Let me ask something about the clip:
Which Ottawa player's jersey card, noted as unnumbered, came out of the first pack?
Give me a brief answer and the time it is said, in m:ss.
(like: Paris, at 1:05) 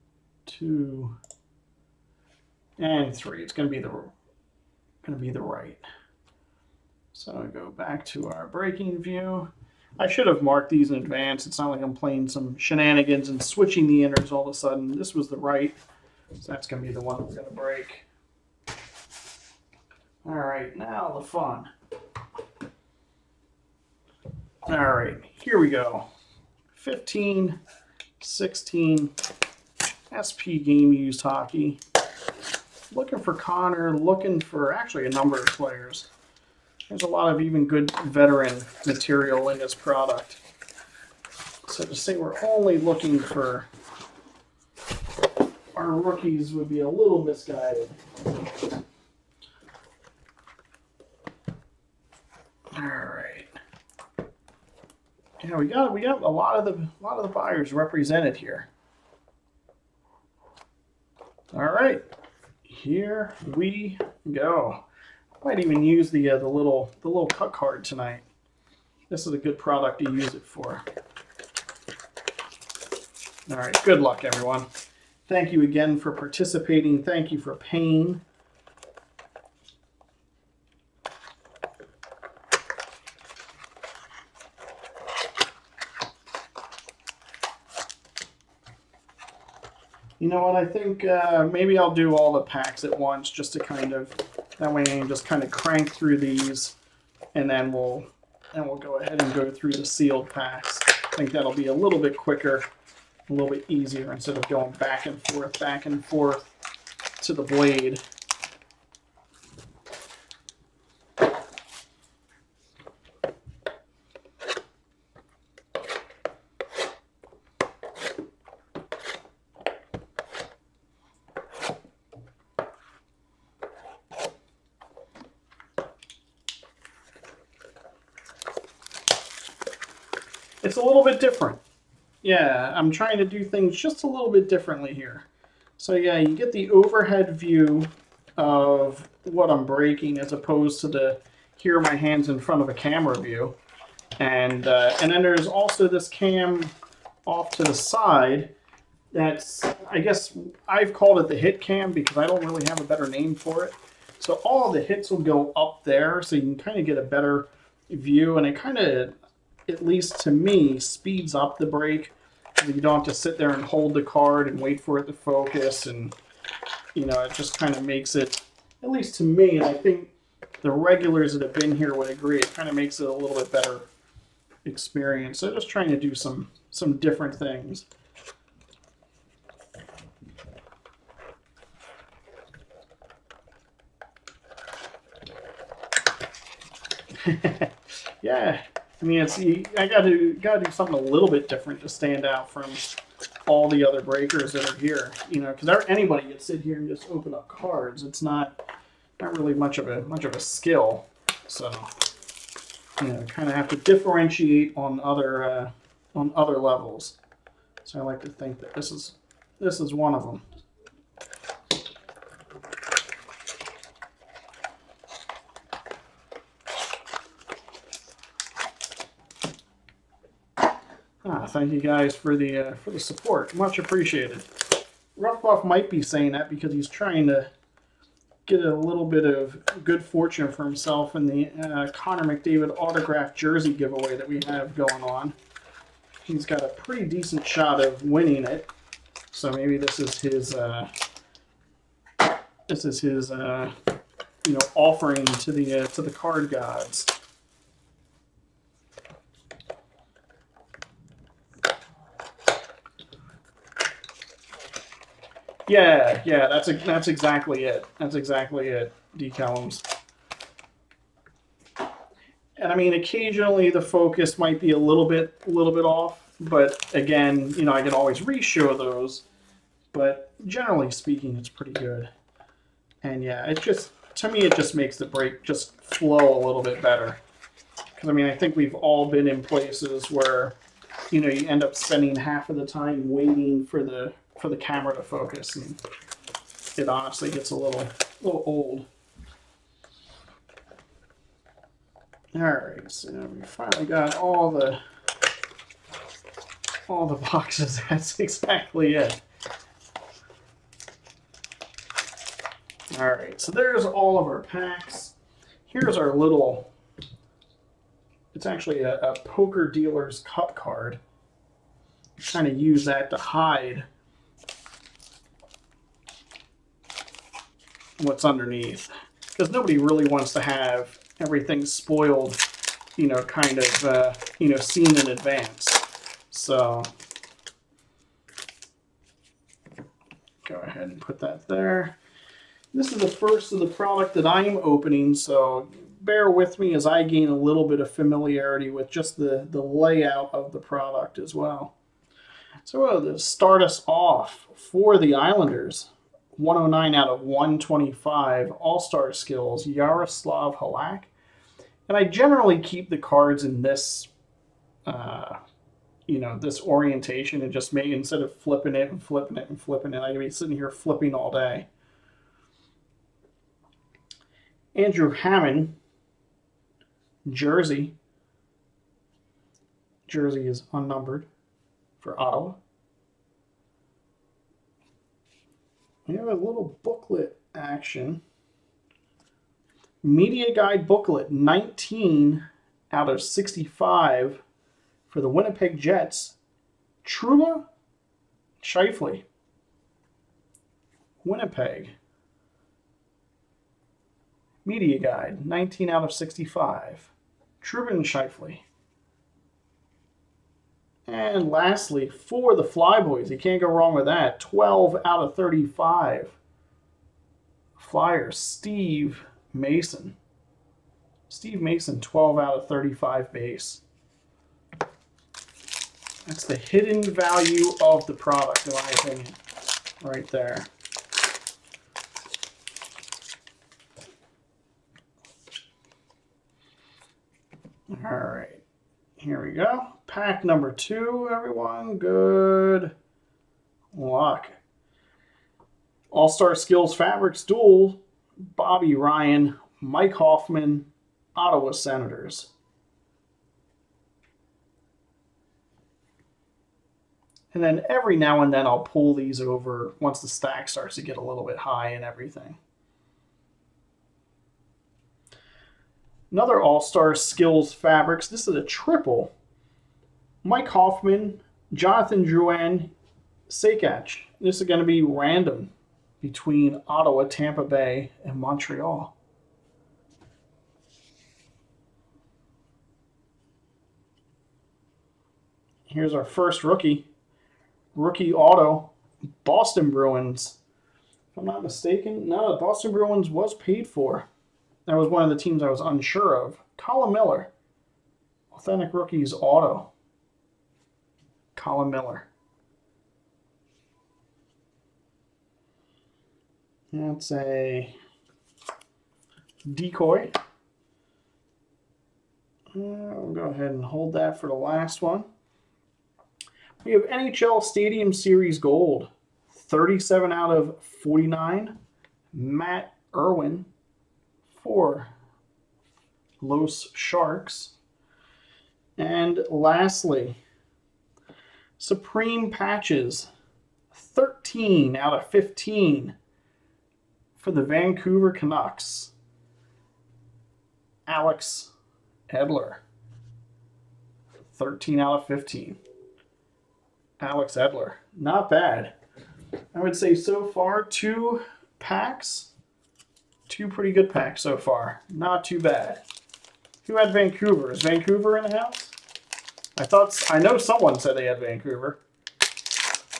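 Andrew Hammond, at 6:04.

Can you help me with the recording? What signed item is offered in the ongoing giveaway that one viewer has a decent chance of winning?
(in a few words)
Connor McDavid autographed jersey.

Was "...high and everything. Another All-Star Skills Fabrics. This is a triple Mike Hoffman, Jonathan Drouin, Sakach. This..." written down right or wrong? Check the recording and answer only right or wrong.
right.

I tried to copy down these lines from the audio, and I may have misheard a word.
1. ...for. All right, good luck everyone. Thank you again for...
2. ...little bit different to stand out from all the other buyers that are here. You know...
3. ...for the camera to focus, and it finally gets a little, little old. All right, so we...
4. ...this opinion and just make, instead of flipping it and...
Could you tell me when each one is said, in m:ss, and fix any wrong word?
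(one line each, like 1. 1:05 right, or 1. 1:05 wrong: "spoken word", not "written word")
1. 1:10 right
2. 3:10 wrong: "breakers", not "buyers"
3. 4:44 wrong: "honestly", not "finally"
4. 5:56 wrong: "orientation", not "opinion".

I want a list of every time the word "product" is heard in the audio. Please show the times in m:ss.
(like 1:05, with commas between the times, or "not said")
0:39, 1:09, 5:33, 5:40, 6:58.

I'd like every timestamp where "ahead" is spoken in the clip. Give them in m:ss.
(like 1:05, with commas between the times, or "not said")
1:38, 5:30, 8:23.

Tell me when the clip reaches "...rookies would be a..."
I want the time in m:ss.
0:45.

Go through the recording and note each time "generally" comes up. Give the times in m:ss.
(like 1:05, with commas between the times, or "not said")
4:30, 5:52.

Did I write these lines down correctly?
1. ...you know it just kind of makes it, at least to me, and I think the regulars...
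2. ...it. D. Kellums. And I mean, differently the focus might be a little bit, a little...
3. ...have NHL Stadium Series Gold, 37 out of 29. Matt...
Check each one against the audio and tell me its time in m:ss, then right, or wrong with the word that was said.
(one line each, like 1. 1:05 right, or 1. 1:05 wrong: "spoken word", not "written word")
1. 2:46 right
2. 4:18 wrong: "occasionally", not "differently"
3. 8:26 wrong: "49", not "29".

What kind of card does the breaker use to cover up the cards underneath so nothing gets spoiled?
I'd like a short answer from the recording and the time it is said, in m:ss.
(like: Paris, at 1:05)
poker dealer's cup card, at 5:09.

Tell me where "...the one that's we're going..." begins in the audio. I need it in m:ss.
0:16.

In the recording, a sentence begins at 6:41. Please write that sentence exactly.
And lastly, for the Flyboys, you can't go wrong with that.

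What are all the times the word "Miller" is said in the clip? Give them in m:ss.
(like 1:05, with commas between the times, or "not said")
8:07, 8:11.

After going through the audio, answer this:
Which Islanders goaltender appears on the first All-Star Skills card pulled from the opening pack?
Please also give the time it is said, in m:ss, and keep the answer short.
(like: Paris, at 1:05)
Jaroslav Halak, at 5:49.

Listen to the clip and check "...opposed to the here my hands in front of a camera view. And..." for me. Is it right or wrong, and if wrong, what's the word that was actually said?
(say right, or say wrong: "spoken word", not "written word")
right.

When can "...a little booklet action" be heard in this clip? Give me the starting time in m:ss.
6:16.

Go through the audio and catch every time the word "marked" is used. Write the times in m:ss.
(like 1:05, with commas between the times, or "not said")
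0:10.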